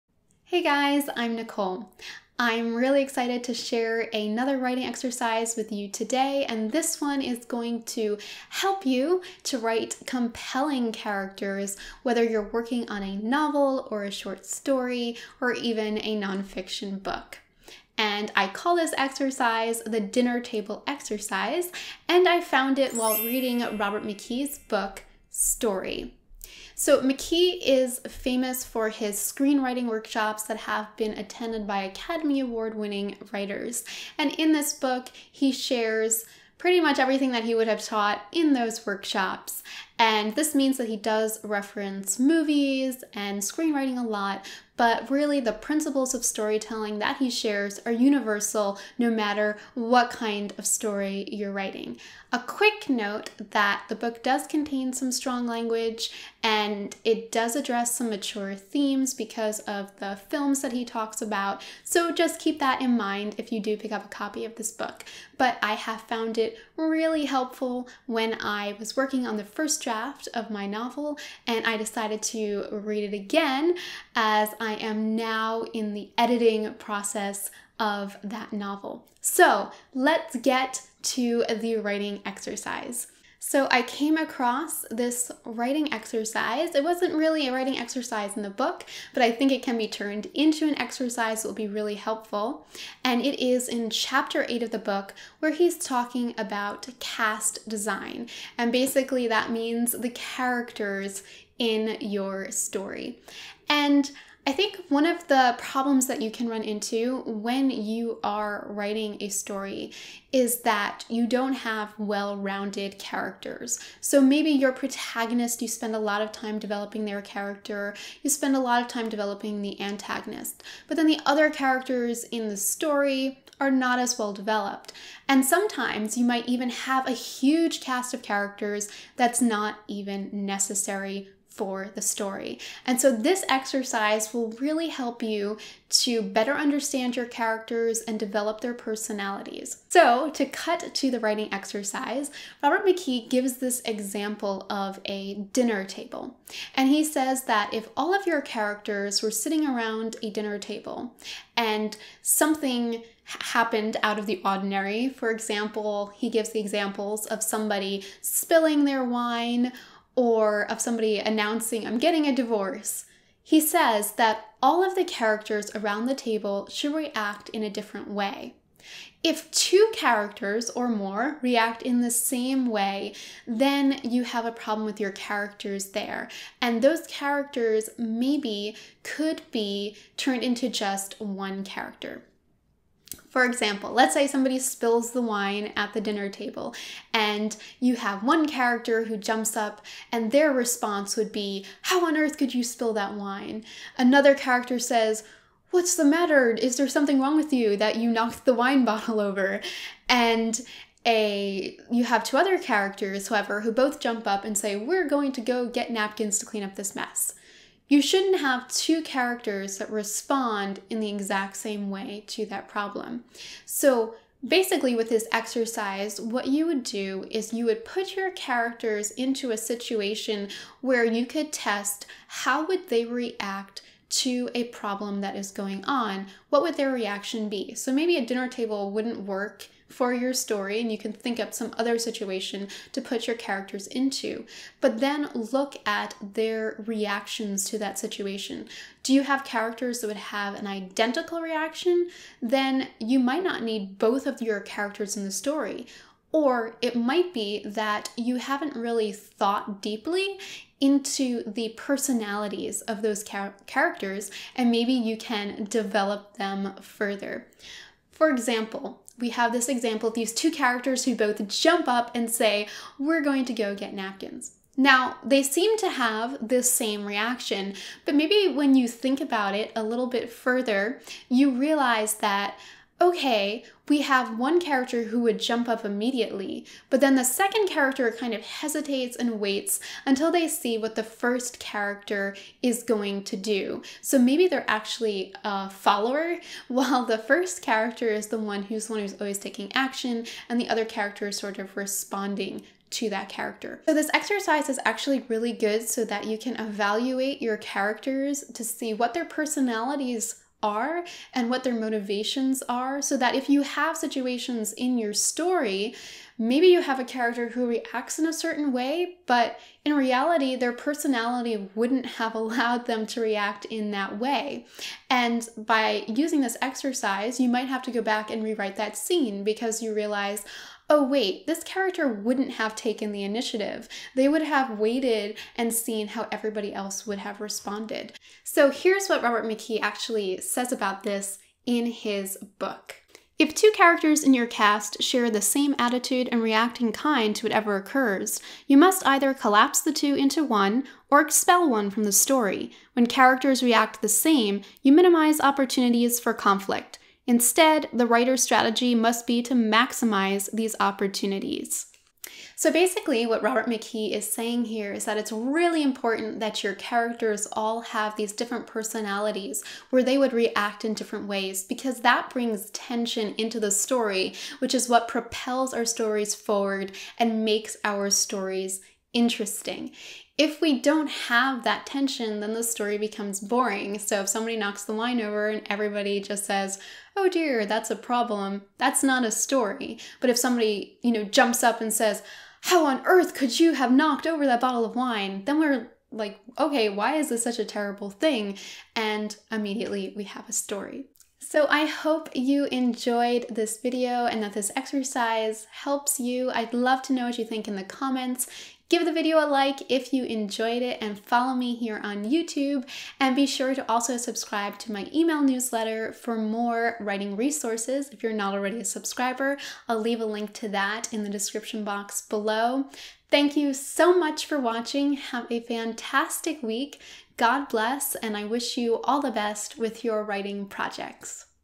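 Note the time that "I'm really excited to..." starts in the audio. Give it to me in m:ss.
0:02.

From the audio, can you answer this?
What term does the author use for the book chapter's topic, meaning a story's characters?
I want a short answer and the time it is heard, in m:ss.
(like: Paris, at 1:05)
cast design, at 1:36.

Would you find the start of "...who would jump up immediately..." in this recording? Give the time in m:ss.
4:35.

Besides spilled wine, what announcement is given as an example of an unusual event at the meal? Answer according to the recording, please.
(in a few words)
I'm getting a divorce.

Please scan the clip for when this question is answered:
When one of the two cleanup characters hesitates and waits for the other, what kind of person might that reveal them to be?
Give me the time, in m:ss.
4:45.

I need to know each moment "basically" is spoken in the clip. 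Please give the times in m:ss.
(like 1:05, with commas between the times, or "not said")
1:38, 3:34, 5:52.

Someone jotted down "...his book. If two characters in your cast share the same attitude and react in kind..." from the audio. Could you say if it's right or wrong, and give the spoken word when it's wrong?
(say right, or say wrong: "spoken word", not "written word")
right.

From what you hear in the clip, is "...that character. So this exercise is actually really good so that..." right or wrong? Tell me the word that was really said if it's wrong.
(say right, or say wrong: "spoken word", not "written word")
right.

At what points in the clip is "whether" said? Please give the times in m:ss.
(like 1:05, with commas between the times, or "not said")
0:12.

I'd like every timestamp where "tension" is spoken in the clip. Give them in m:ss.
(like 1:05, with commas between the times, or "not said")
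6:02, 6:11.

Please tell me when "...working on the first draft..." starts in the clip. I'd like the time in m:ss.
1:08.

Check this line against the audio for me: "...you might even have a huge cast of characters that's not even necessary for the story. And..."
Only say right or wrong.
right.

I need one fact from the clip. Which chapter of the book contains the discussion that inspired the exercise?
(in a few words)
8.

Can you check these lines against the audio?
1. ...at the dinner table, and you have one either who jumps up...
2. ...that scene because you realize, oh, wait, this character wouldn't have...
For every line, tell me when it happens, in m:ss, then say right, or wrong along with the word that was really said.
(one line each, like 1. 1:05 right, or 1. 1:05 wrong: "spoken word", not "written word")
1. 3:05 wrong: "character", not "either"
2. 5:18 right.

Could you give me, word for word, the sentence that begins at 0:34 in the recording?
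And in this book, he shares pretty much everything that he would have taught in those workshops.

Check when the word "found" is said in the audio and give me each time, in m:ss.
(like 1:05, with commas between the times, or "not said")
0:22, 1:06.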